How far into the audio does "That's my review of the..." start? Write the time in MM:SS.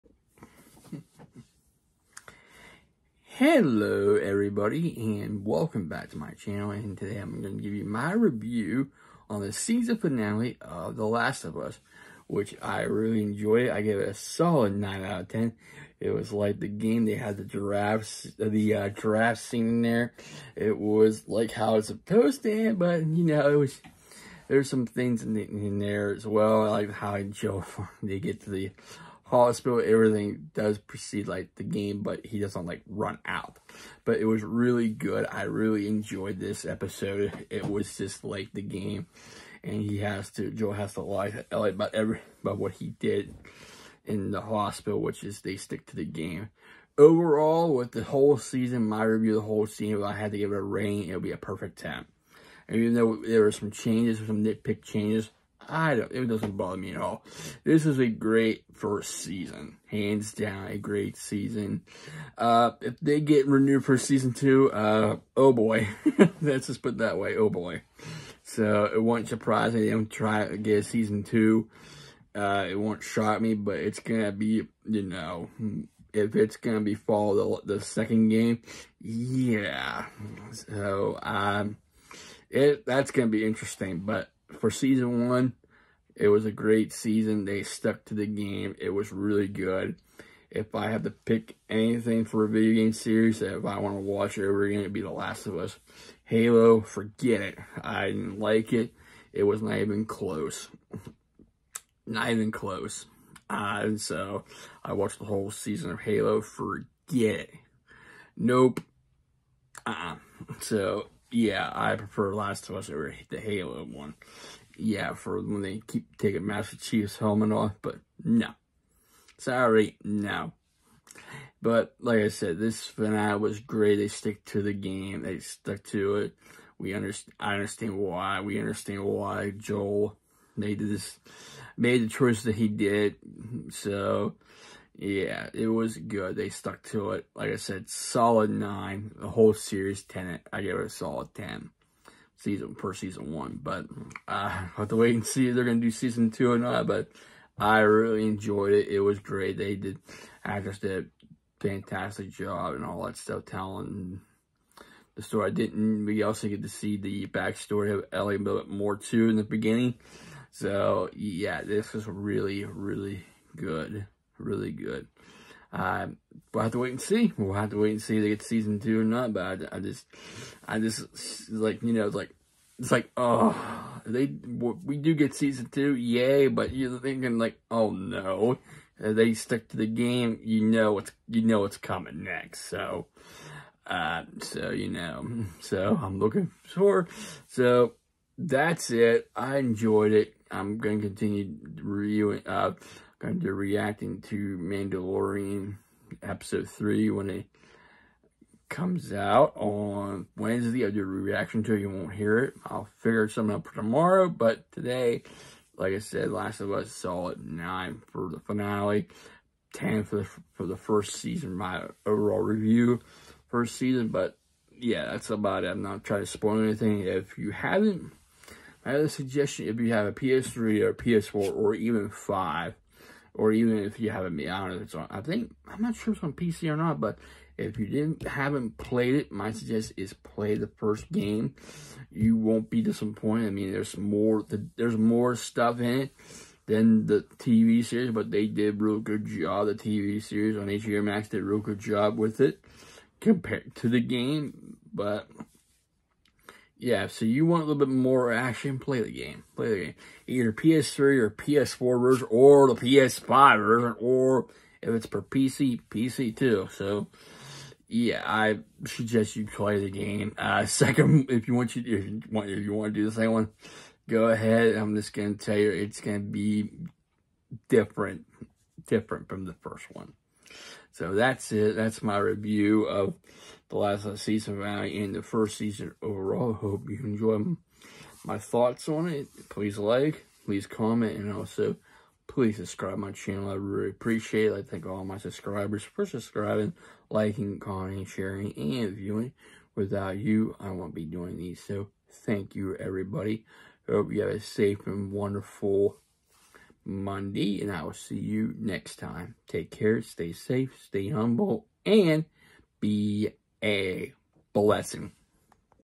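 04:31.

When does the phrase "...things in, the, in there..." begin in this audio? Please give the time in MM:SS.
00:24.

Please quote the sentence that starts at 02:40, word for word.
So yeah, this was really, really good, really good.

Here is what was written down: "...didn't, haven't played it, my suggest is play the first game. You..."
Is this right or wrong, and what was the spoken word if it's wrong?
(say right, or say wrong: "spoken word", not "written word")
right.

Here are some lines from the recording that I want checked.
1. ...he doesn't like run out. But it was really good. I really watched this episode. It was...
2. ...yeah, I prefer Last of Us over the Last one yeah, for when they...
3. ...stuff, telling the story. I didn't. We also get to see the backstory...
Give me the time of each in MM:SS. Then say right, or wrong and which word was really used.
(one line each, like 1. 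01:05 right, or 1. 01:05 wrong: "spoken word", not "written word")
1. 00:32 wrong: "enjoyed", not "watched"
2. 01:51 wrong: "Halo", not "Last"
3. 02:33 right.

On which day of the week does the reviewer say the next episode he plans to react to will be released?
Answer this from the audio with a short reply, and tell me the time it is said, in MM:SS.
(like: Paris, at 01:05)
Wednesday, at 03:20.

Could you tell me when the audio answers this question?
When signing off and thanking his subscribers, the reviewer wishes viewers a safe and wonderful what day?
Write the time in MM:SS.
04:56.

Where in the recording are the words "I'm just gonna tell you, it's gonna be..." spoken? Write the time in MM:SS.
04:24.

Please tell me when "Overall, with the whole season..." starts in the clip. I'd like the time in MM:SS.
00:46.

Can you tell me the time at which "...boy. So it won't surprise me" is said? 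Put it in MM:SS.
01:07.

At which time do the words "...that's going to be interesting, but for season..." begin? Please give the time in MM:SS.
01:22.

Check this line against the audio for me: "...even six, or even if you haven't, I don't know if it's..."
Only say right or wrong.
wrong.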